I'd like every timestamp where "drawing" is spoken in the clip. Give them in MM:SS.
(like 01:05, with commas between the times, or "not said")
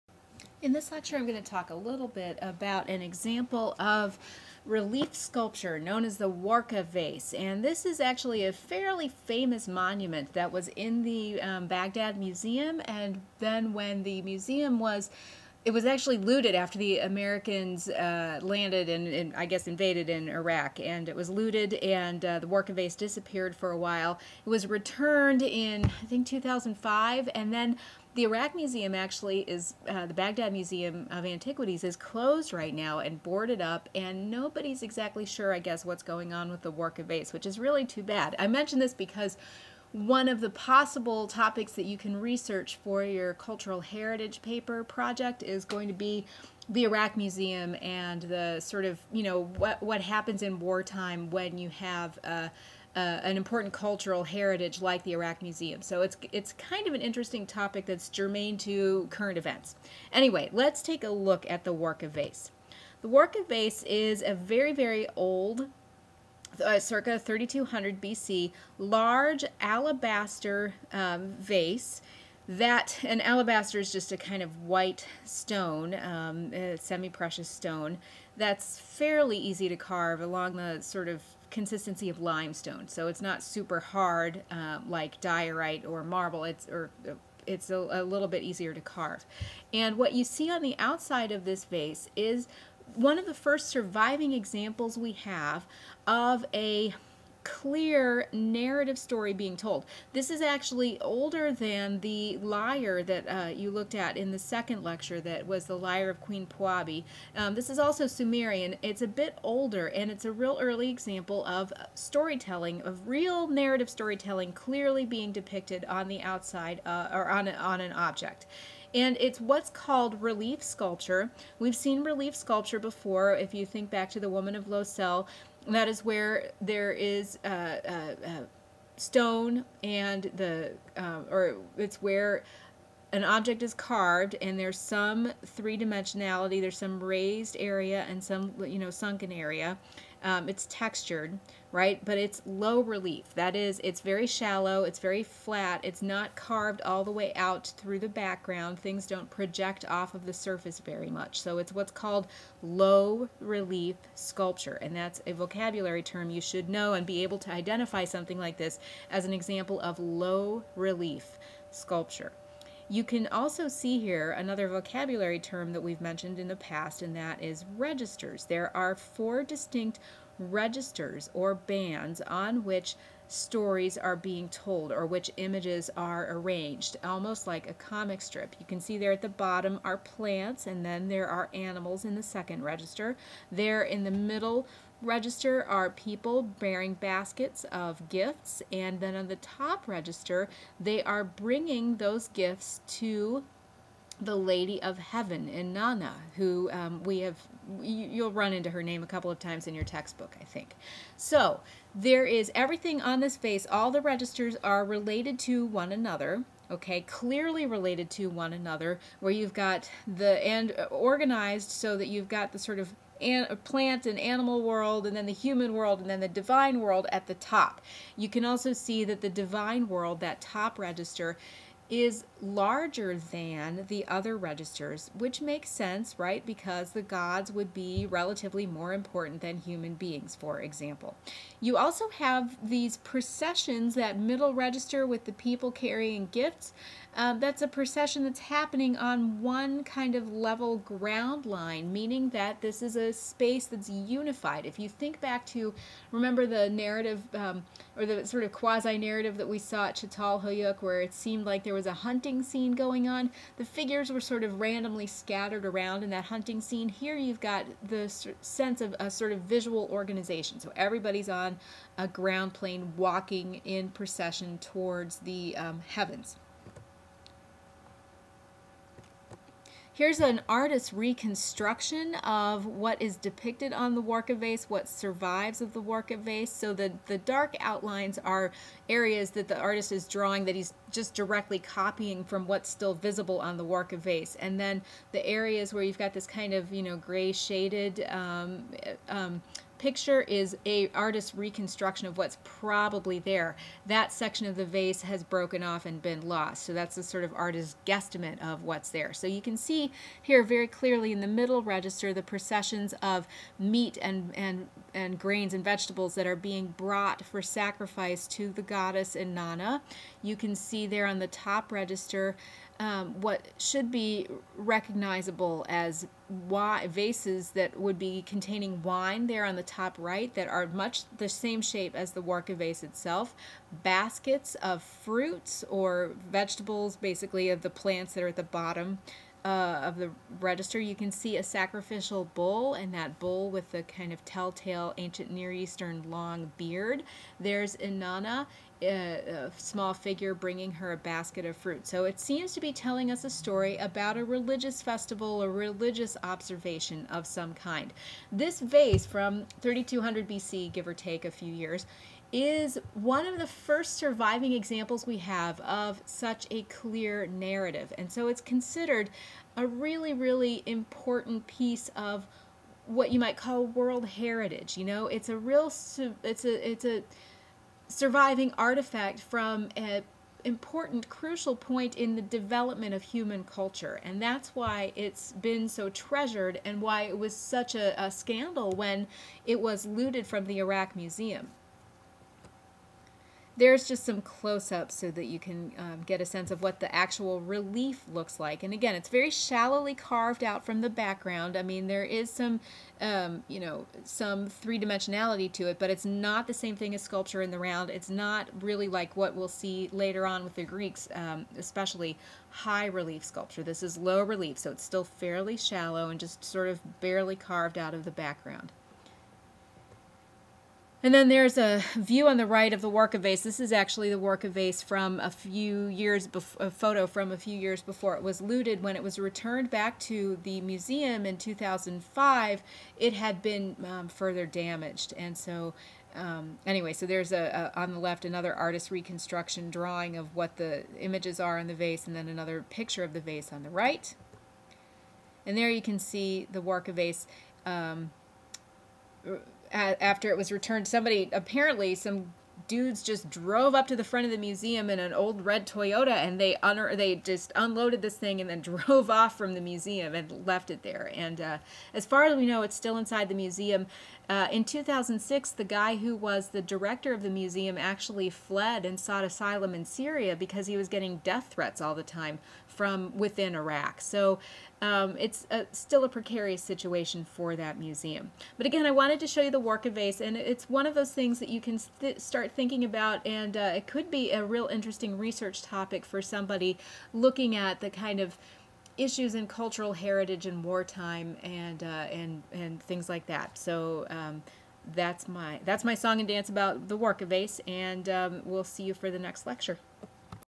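04:40, 07:09.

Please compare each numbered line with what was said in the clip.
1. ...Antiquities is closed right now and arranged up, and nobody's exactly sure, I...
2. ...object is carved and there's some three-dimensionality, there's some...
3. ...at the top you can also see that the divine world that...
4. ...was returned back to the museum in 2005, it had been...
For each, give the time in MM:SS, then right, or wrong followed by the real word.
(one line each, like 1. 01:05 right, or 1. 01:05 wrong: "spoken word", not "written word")
1. 00:31 wrong: "boarded", not "arranged"
2. 02:13 right
3. 03:37 right
4. 06:59 right.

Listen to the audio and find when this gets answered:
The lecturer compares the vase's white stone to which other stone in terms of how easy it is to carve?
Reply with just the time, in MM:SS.
01:22.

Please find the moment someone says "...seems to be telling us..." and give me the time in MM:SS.
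05:42.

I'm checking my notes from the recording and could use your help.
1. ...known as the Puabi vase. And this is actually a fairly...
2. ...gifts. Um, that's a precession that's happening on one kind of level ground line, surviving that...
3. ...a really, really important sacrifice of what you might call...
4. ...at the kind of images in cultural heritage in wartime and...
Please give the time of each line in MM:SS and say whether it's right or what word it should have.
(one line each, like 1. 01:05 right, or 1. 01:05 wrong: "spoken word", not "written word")
1. 00:05 wrong: "Warka", not "Puabi"
2. 03:56 wrong: "meaning", not "surviving"
3. 05:59 wrong: "piece", not "sacrifice"
4. 07:57 wrong: "issues", not "images".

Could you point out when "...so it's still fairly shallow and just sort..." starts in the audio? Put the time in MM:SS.
06:44.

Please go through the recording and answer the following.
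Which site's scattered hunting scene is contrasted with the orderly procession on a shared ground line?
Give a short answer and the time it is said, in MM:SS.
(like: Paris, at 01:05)
Catalhoyuk, at 04:09.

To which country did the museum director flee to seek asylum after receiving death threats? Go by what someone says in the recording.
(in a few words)
Syria.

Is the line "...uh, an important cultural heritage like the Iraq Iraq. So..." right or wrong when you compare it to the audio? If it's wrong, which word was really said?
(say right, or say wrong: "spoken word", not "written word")
wrong: "Museum", not "Iraq".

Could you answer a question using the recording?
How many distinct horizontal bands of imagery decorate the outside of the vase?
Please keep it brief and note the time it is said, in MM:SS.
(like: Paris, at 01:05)
4, at 02:48.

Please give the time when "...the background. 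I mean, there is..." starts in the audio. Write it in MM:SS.
06:30.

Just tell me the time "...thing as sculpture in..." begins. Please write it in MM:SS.
06:36.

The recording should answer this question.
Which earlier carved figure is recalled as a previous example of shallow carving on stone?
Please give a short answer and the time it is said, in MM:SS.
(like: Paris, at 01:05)
Woman of Laussel, at 02:04.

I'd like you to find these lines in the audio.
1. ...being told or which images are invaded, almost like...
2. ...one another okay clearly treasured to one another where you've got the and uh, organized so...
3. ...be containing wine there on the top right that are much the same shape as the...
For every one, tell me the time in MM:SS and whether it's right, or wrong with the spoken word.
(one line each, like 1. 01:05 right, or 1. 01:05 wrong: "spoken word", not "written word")
1. 02:54 wrong: "arranged", not "invaded"
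2. 03:25 wrong: "related", not "treasured"
3. 05:17 right.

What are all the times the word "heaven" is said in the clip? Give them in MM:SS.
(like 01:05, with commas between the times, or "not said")
03:14, 04:25.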